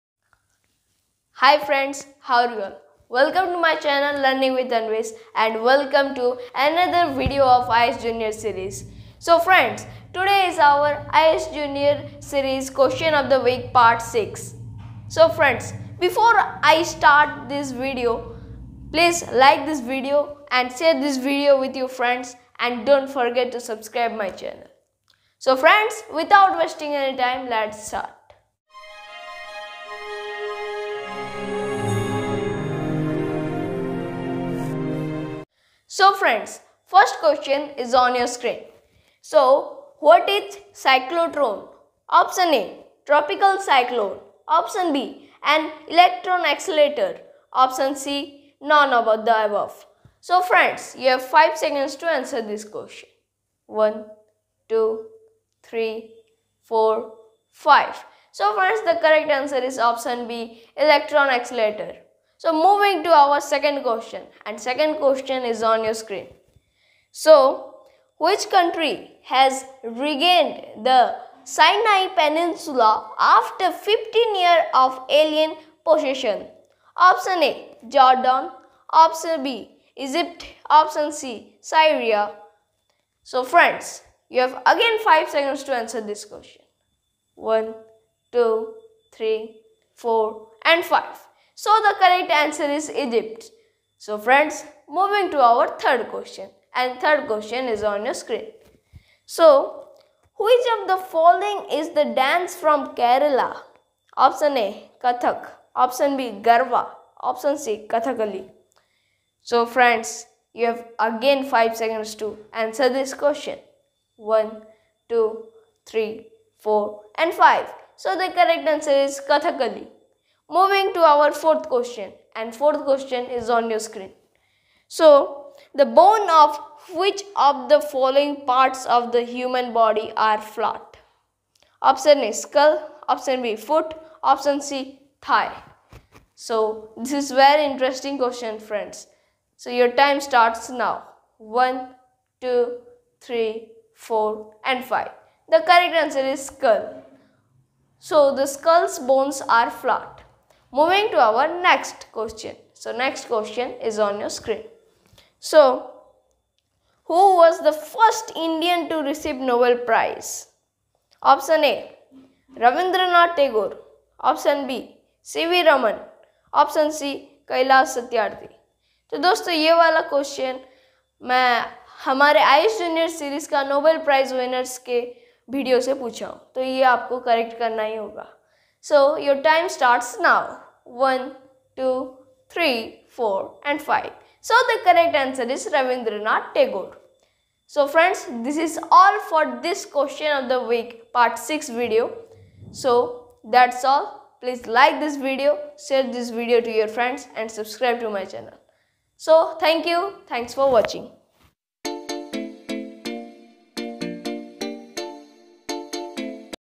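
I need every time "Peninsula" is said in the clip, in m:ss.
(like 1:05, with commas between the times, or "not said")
1:12.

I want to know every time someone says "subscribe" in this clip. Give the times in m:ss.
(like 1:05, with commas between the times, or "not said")
0:23, 3:17.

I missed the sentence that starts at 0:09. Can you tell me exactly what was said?
So friends, today is our IAS Junior series question of the week part 6.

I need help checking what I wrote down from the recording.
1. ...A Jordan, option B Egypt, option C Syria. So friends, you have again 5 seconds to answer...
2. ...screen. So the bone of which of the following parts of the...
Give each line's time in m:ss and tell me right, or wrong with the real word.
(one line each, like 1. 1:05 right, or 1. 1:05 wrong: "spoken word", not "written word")
1. 1:17 right
2. 2:03 right.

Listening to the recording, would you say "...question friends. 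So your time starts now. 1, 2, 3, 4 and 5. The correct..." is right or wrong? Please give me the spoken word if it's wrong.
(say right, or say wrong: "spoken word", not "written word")
right.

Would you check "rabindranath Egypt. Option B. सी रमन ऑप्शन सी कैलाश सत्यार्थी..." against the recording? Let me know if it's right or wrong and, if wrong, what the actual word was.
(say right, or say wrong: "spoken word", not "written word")
wrong: "Tagore", not "Egypt".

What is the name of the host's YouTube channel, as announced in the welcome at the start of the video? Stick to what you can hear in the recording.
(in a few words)
Learning with Anwesh.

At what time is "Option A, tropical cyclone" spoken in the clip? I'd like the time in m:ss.
0:42.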